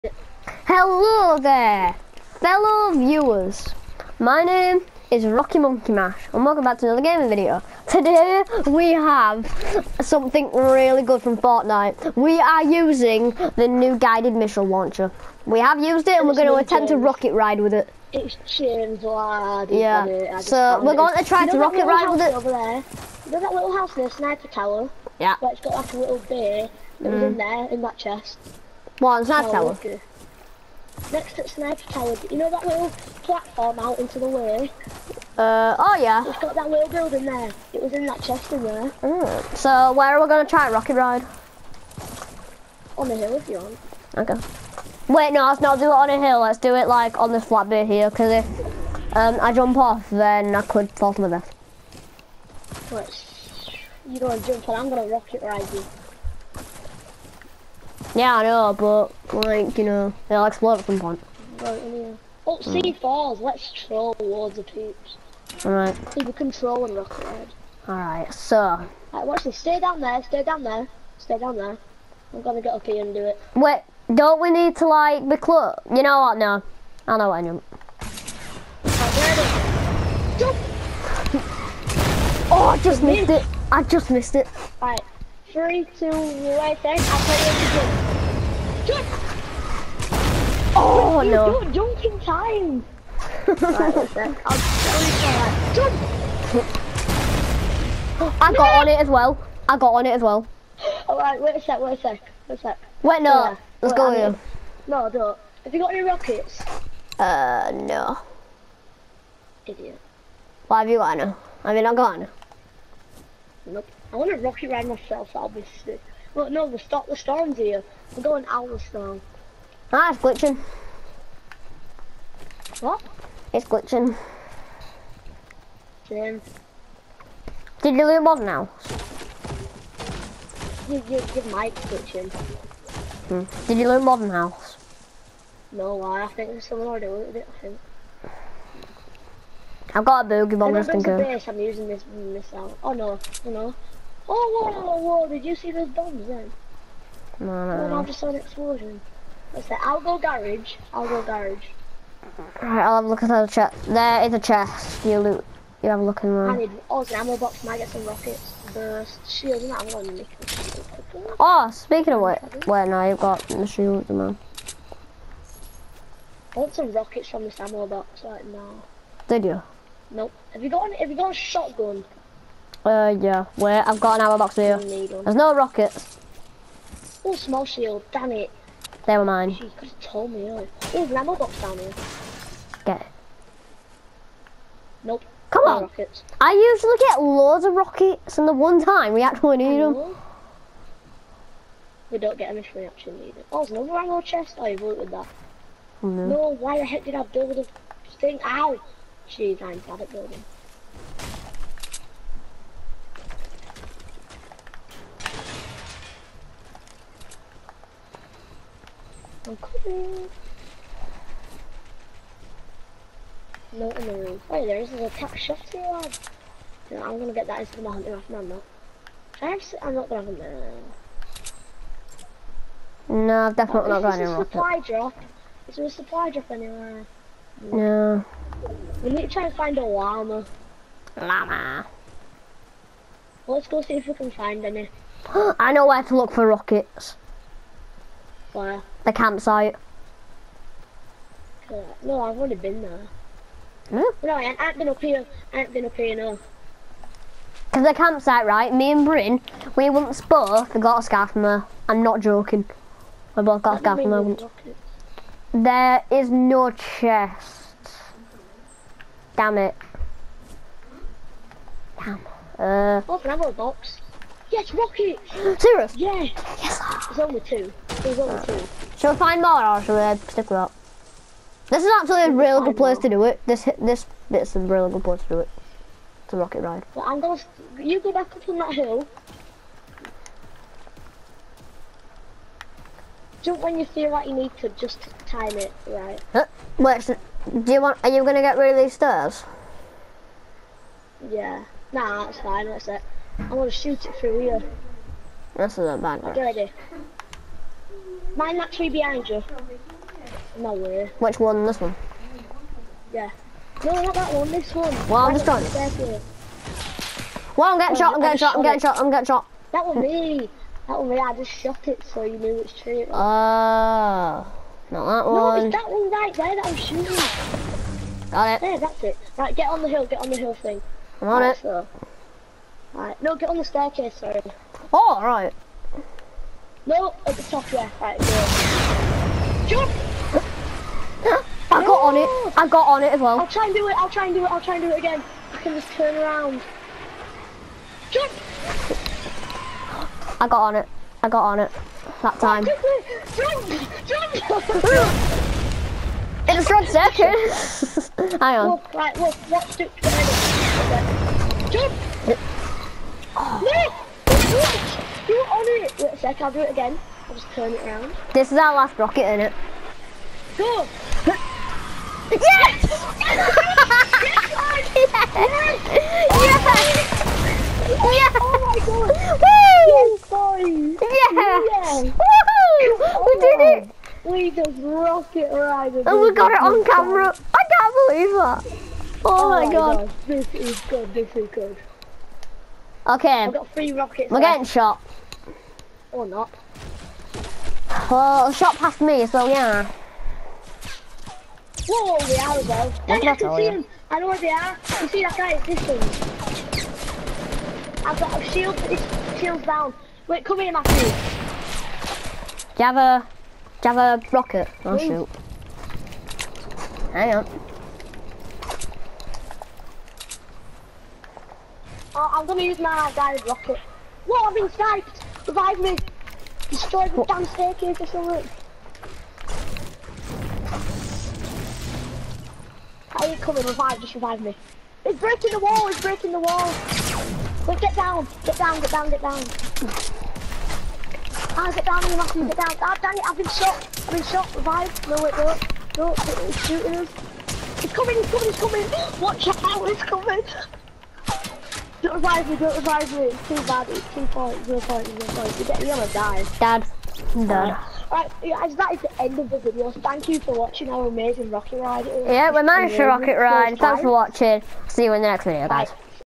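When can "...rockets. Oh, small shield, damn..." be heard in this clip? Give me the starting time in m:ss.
2:55.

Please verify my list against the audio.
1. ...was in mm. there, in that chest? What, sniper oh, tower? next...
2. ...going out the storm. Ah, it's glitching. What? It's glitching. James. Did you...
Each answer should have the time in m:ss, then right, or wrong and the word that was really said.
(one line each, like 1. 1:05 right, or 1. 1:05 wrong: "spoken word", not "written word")
1. 0:27 right
2. 1:58 right.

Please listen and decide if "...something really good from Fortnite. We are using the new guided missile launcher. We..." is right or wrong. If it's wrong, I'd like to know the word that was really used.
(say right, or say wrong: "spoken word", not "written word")
right.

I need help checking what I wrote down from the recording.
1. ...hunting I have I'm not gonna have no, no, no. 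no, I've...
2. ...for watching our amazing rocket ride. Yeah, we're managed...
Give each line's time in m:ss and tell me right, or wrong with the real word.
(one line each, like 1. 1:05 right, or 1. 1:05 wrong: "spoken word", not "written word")
1. 3:37 right
2. 7:30 right.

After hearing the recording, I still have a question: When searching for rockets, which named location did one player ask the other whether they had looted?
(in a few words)
Modern House.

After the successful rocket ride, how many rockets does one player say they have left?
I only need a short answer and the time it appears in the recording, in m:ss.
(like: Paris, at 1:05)
3, at 6:23.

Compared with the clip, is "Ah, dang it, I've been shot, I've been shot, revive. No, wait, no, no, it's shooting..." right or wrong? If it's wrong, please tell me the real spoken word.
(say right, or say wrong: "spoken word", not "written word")
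right.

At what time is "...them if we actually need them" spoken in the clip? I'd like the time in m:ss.
3:12.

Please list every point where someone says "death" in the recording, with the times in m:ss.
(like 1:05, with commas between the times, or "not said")
0:51.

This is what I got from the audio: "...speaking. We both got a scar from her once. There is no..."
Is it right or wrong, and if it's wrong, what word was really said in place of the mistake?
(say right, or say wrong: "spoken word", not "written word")
wrong: "joking", not "speaking".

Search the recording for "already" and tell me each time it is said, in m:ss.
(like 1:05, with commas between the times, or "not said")
2:16, 4:02.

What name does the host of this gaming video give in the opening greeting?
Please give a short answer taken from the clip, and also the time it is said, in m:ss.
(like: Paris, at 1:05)
Rockymunkymash, at 0:05.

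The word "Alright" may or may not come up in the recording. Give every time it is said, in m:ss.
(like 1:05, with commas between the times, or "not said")
1:09, 1:41, 2:32, 7:27.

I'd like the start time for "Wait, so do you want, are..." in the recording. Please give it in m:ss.
4:46.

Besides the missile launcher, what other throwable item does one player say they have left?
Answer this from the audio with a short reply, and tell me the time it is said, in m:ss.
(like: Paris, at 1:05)
boogie bomb, at 2:20.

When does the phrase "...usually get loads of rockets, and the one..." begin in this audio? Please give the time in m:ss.
3:06.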